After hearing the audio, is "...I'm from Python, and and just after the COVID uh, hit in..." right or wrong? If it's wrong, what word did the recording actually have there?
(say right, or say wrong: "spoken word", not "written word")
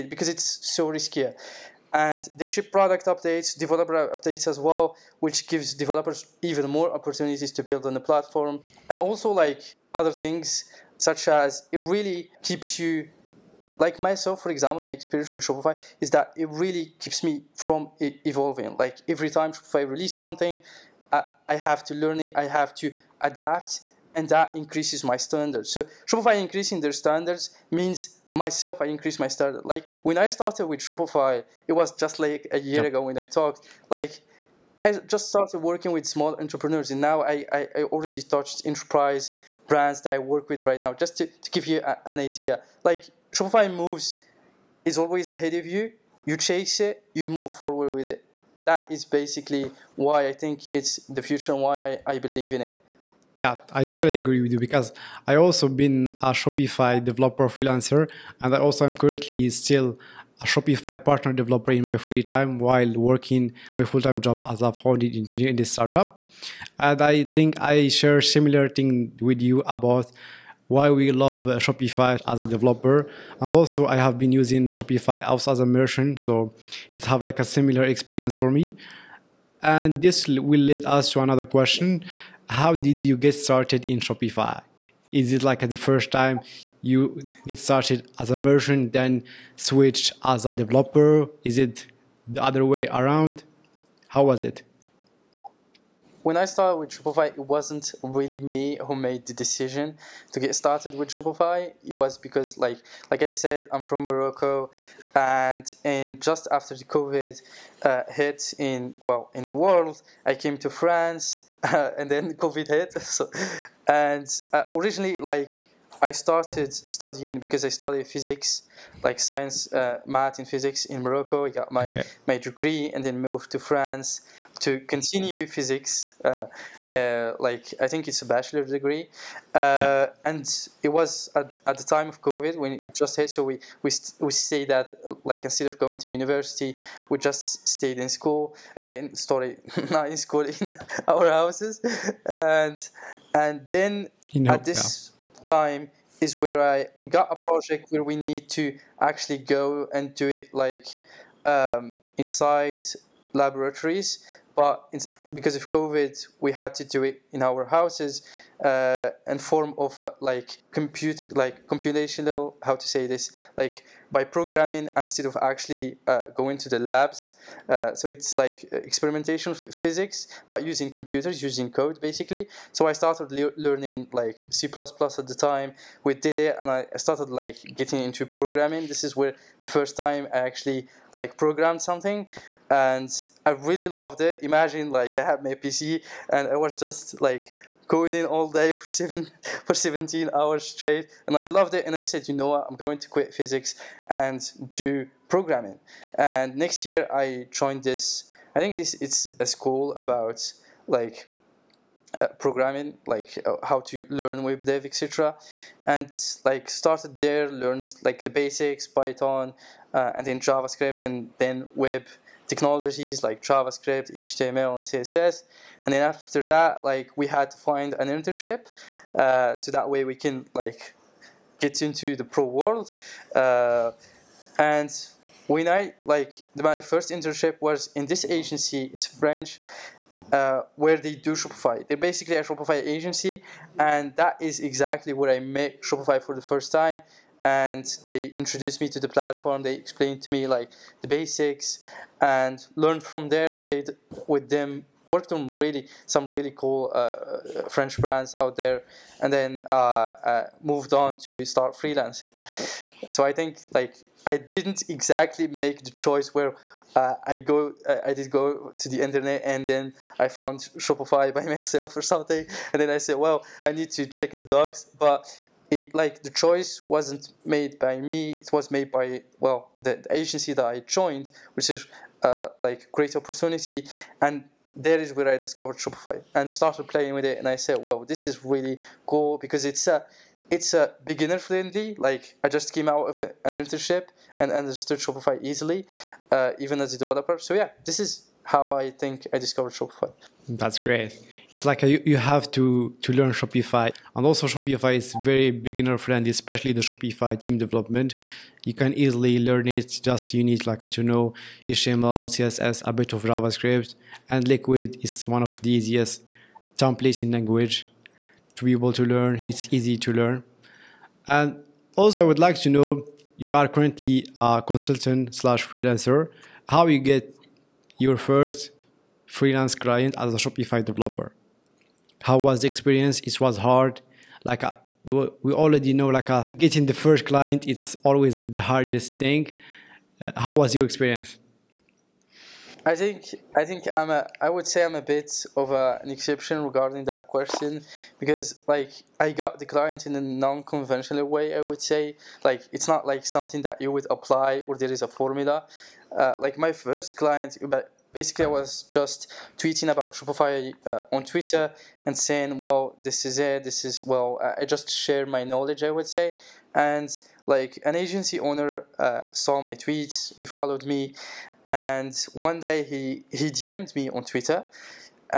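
wrong: "Morocco", not "Python".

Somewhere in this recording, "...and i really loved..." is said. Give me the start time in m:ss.
3:02.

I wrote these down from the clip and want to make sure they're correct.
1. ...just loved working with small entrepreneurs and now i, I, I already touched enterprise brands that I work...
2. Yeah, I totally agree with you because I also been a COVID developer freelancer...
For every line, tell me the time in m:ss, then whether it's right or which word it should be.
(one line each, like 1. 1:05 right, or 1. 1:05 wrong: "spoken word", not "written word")
1. 0:35 wrong: "started", not "loved"
2. 0:53 wrong: "Shopify", not "COVID".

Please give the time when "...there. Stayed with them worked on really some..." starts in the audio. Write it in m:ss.
4:03.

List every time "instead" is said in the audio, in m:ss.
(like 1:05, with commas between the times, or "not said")
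2:15, 2:44.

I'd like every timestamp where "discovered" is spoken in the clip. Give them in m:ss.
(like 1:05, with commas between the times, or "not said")
4:35, 4:49.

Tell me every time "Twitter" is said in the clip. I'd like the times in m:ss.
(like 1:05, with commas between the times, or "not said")
5:51, 6:04.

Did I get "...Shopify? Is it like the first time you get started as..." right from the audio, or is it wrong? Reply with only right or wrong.
right.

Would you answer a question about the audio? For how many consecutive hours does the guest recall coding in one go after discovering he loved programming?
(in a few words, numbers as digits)
17.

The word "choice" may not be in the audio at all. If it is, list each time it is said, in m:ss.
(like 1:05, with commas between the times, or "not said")
4:15, 4:26.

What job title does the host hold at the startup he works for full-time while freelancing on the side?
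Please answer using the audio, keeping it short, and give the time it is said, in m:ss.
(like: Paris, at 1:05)
Founding engineer, at 1:04.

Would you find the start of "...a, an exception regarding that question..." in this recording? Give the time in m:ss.
5:35.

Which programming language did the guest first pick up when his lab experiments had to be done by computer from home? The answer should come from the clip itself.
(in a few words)
C++.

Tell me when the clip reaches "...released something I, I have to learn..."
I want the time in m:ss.
0:19.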